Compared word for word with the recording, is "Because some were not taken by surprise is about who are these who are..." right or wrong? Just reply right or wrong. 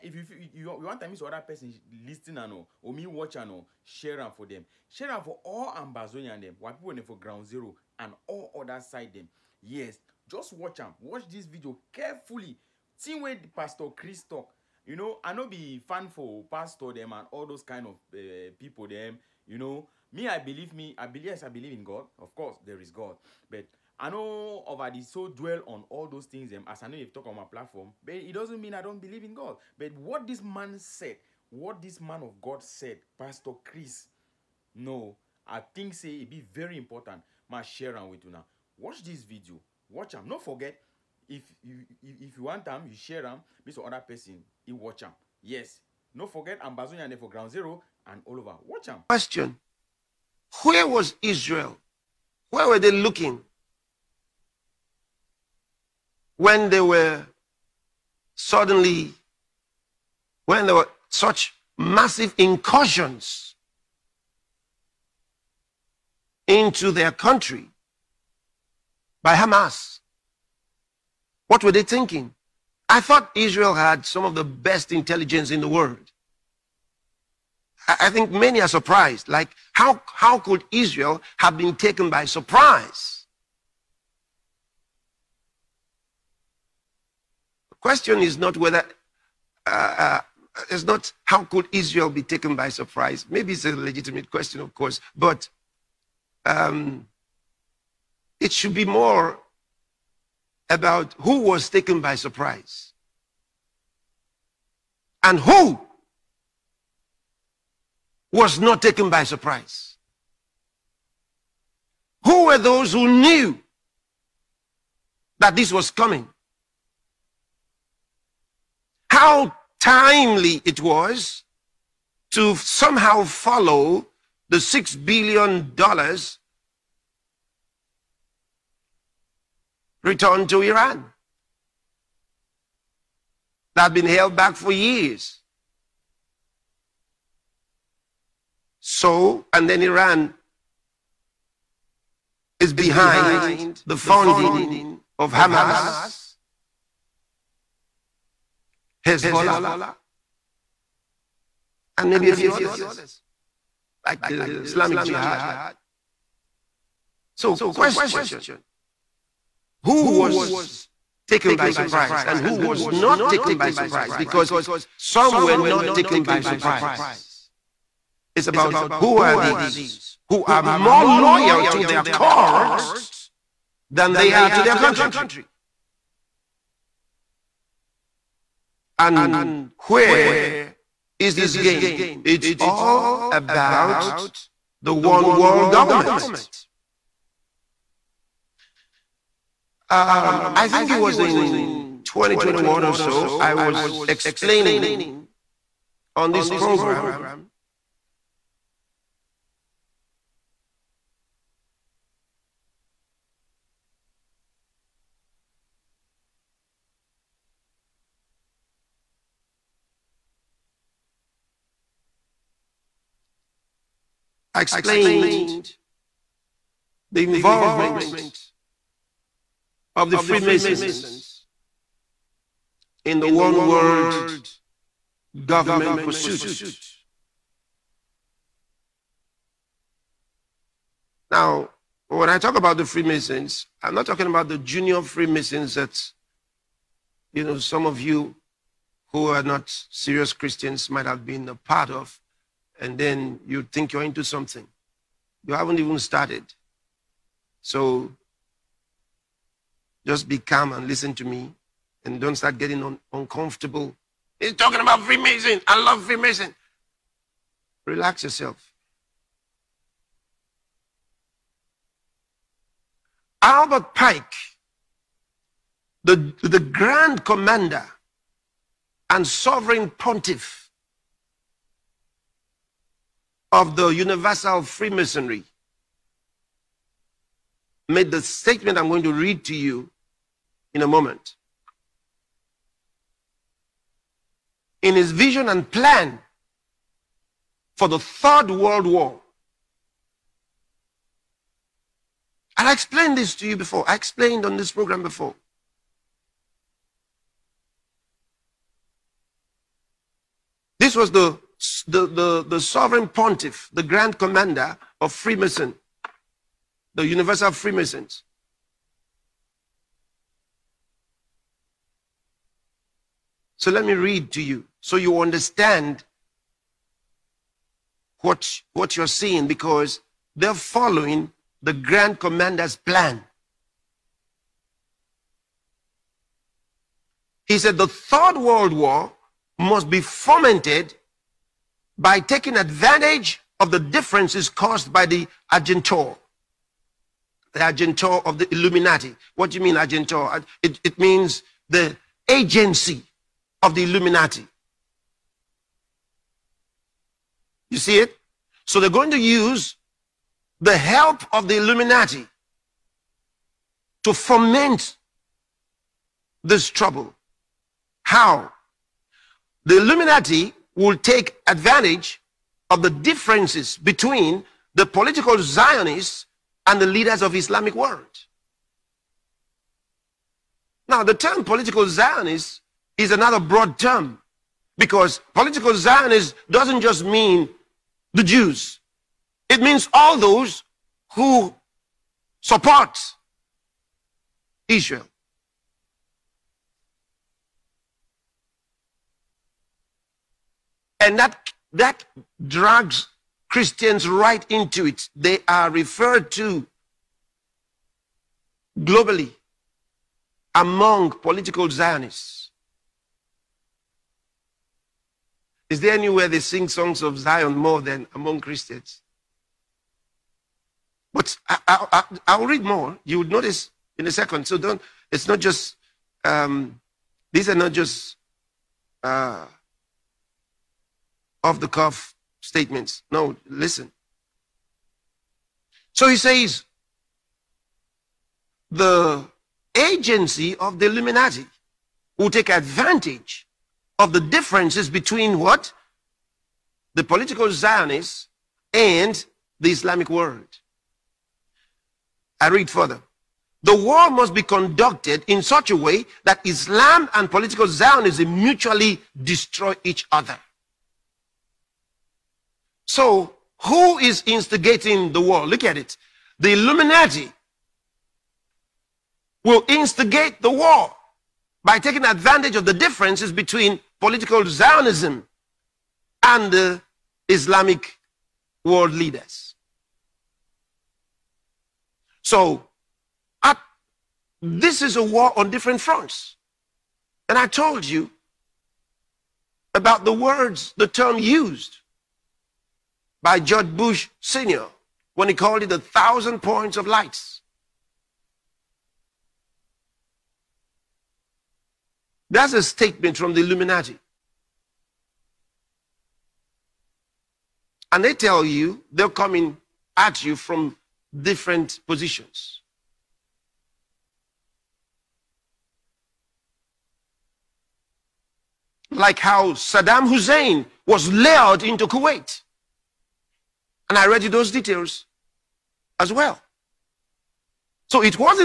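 right.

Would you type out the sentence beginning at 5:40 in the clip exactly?
Uh, it, it means the agency of the Illuminati.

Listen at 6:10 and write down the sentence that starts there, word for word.
Now, the term political Zionist is another broad term because political Zionist doesn't just mean the Jews.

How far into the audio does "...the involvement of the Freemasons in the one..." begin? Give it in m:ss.
3:37.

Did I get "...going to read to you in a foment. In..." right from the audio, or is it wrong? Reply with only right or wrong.
wrong.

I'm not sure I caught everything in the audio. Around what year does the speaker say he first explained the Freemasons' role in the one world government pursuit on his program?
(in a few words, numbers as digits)
2021.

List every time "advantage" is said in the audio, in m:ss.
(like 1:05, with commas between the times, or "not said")
5:32, 6:01, 7:12, 7:42.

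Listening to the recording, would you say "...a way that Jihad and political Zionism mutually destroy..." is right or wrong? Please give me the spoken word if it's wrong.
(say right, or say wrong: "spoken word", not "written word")
wrong: "Islam", not "Jihad".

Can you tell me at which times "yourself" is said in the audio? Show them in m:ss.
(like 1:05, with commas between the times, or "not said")
4:18.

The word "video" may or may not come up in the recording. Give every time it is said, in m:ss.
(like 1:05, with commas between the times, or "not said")
0:11, 0:39.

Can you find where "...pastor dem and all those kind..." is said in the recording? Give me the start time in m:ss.
0:16.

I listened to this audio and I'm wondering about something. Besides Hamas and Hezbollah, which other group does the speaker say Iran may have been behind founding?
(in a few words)
Islamic Jihad.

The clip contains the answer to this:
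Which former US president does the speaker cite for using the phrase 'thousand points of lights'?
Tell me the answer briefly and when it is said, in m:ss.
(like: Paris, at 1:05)
George Bush Sr., at 8:03.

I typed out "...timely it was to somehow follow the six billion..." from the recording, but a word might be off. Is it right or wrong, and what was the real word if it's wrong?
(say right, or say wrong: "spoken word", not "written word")
right.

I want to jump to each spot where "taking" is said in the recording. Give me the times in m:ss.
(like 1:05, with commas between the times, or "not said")
5:32, 7:41.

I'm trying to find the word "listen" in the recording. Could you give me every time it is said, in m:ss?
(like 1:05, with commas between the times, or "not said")
4:10, 7:03.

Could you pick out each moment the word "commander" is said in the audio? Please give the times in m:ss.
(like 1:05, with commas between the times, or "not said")
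4:27, 5:04, 5:22.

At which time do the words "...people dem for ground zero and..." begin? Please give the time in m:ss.
0:06.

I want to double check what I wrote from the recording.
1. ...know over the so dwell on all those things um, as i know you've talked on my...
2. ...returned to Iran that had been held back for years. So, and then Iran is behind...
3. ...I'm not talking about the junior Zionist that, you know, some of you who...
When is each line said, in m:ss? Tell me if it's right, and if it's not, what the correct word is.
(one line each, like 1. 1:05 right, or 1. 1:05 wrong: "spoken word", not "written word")
1. 0:24 right
2. 2:10 right
3. 3:53 wrong: "Freemasons", not "Zionist".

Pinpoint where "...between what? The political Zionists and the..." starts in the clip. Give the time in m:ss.
7:14.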